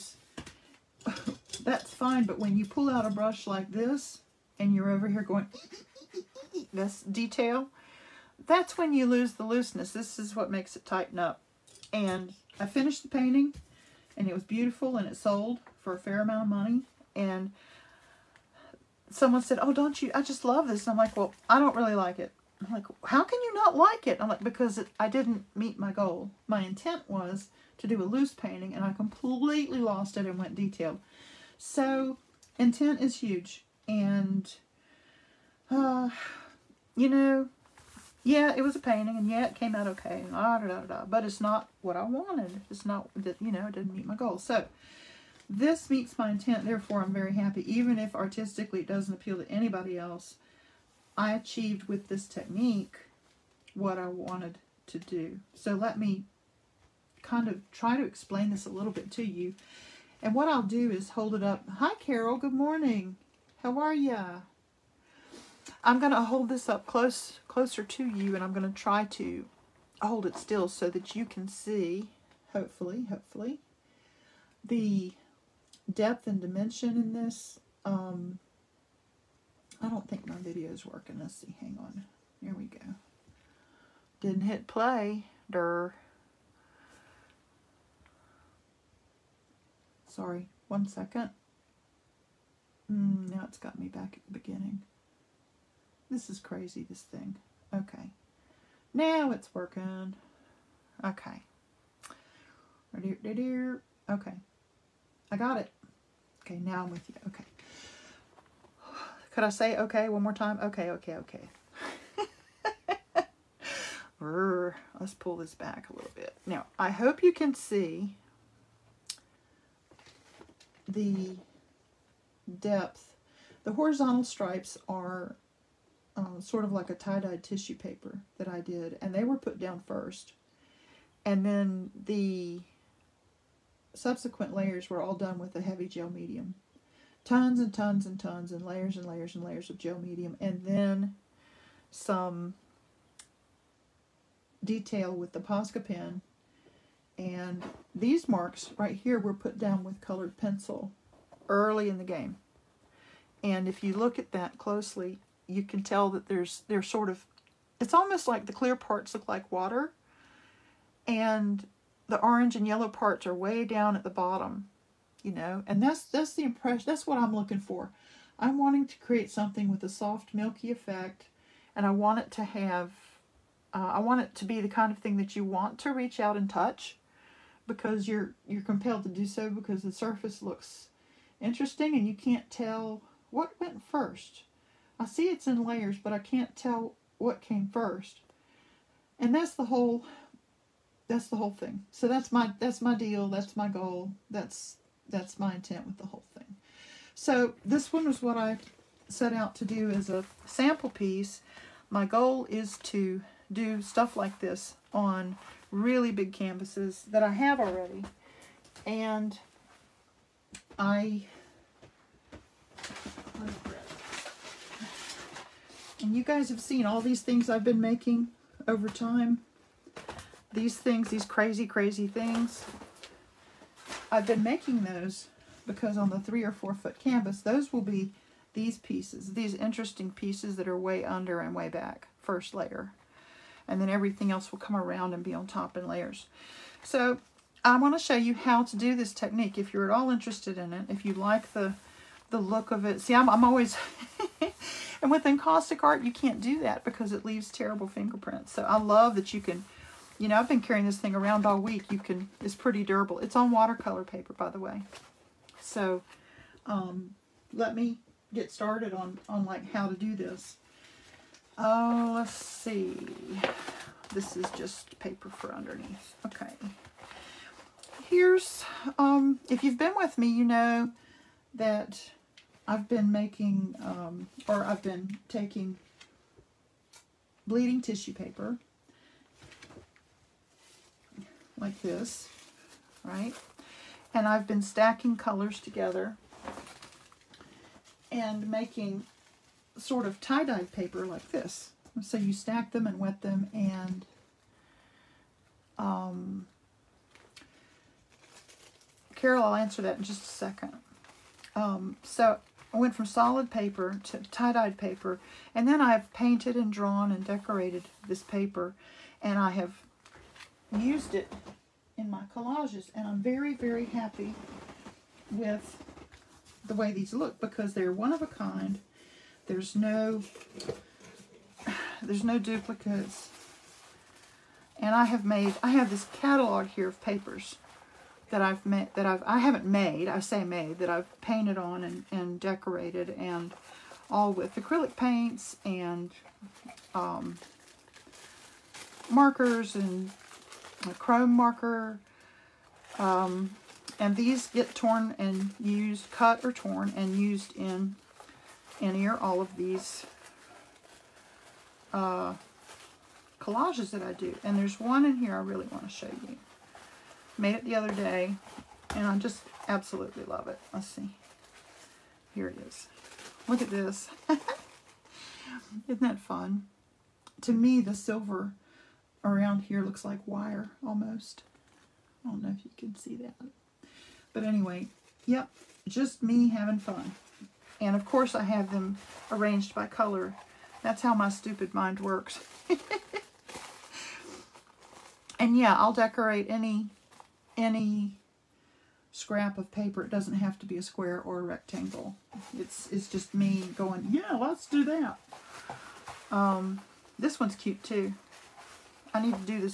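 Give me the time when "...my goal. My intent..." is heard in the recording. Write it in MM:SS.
00:25.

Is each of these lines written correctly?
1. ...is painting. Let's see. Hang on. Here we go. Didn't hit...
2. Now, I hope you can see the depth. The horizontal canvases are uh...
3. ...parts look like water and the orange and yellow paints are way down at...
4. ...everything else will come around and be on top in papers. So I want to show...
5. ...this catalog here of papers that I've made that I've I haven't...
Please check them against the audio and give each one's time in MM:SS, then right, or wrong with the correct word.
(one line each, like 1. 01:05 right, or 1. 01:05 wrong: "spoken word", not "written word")
1. 01:20 wrong: "working", not "painting"
2. 01:56 wrong: "stripes", not "canvases"
3. 02:38 wrong: "parts", not "paints"
4. 03:53 wrong: "layers", not "papers"
5. 05:25 right.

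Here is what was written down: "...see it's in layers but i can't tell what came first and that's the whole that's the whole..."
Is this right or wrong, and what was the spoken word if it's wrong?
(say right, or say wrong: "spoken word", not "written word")
right.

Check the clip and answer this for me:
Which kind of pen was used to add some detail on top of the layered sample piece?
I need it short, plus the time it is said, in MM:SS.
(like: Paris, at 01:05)
Posca pen, at 02:25.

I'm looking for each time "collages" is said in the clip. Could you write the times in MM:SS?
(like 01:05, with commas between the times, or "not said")
05:12, 05:53.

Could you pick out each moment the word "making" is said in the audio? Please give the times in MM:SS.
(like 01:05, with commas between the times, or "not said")
03:37, 03:44, 04:33, 04:48.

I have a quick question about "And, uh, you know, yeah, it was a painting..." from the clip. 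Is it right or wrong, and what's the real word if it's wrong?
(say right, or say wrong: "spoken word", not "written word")
right.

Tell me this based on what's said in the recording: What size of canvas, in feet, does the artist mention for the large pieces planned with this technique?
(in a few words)
3 or 4 foot.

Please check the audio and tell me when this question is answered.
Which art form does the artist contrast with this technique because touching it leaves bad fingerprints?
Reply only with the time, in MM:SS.
04:05.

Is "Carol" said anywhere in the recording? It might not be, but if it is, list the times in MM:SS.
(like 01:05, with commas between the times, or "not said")
01:01, 04:59.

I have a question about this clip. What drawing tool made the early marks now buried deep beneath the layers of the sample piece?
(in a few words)
colored pencil.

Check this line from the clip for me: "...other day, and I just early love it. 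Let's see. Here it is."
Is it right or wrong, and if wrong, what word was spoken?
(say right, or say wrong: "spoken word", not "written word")
wrong: "absolutely", not "early".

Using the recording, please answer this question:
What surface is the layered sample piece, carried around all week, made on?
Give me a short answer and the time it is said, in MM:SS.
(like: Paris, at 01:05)
watercolor paper, at 04:13.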